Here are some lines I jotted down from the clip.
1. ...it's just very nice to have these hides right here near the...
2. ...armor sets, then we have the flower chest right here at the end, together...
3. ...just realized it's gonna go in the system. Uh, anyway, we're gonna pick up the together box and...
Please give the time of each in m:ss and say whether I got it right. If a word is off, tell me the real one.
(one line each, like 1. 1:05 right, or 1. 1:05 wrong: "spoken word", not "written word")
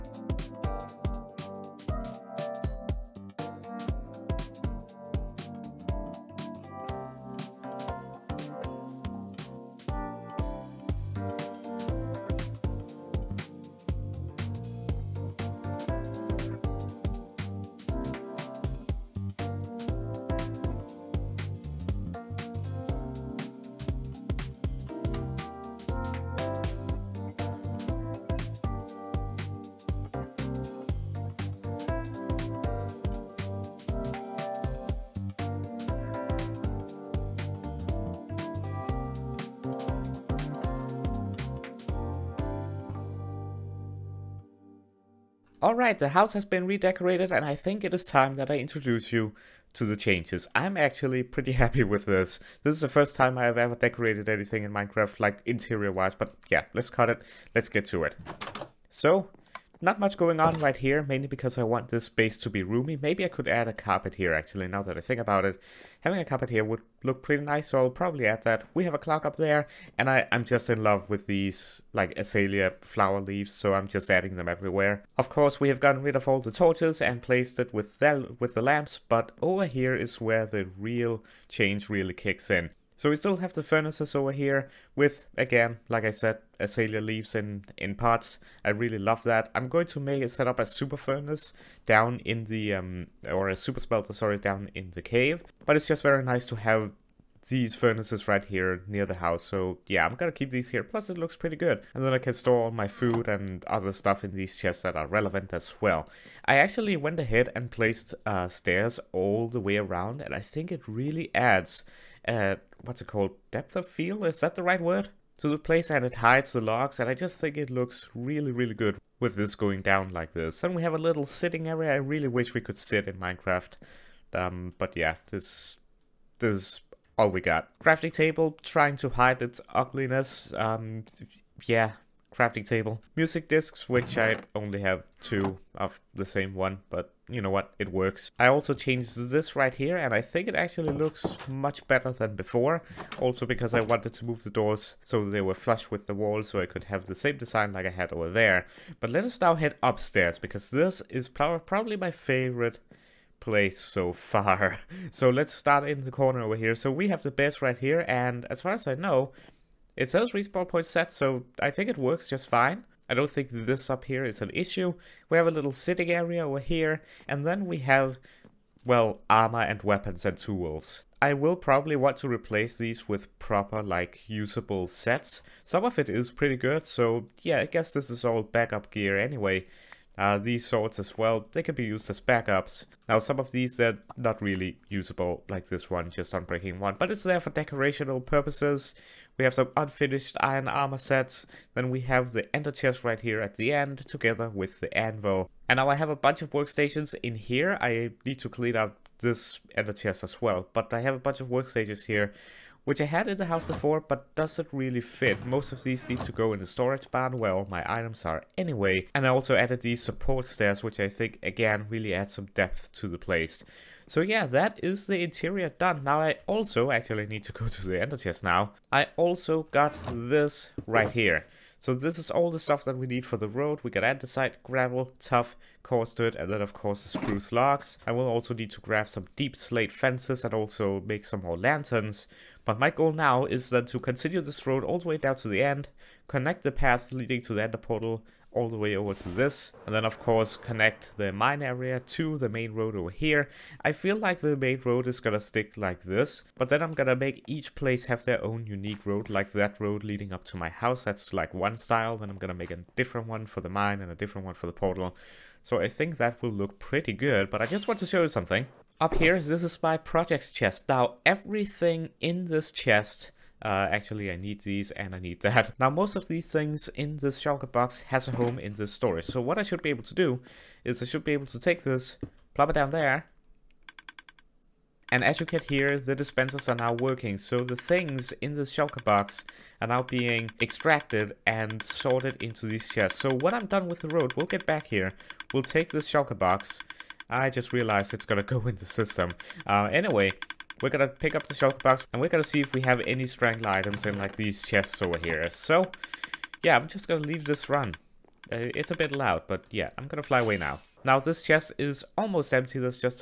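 1. 1:35 wrong: "furnaces", not "hides"
2. 3:10 wrong: "ender", not "flower"
3. 4:47 wrong: "shulker", not "together".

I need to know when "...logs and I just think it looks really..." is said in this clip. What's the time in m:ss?
1:56.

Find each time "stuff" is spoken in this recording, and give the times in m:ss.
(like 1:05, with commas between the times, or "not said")
1:43, 3:42.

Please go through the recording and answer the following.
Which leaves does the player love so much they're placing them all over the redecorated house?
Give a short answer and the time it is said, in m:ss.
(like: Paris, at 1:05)
Azalea flower leaves, at 1:12.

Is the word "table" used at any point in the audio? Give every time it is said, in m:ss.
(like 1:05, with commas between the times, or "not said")
2:08, 2:12.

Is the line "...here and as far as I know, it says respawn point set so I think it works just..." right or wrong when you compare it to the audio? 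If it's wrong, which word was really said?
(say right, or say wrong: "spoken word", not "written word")
right.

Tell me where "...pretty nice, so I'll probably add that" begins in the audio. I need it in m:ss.
1:07.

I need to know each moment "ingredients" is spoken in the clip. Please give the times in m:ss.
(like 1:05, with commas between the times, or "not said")
not said.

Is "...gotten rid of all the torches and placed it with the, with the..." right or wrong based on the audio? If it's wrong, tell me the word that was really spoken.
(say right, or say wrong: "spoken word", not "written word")
right.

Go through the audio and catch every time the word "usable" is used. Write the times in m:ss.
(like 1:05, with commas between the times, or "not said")
2:54, 3:04.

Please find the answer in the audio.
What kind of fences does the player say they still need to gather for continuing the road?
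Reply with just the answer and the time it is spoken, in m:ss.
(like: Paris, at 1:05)
Deepslate fences, at 3:49.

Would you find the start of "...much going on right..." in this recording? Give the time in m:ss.
0:59.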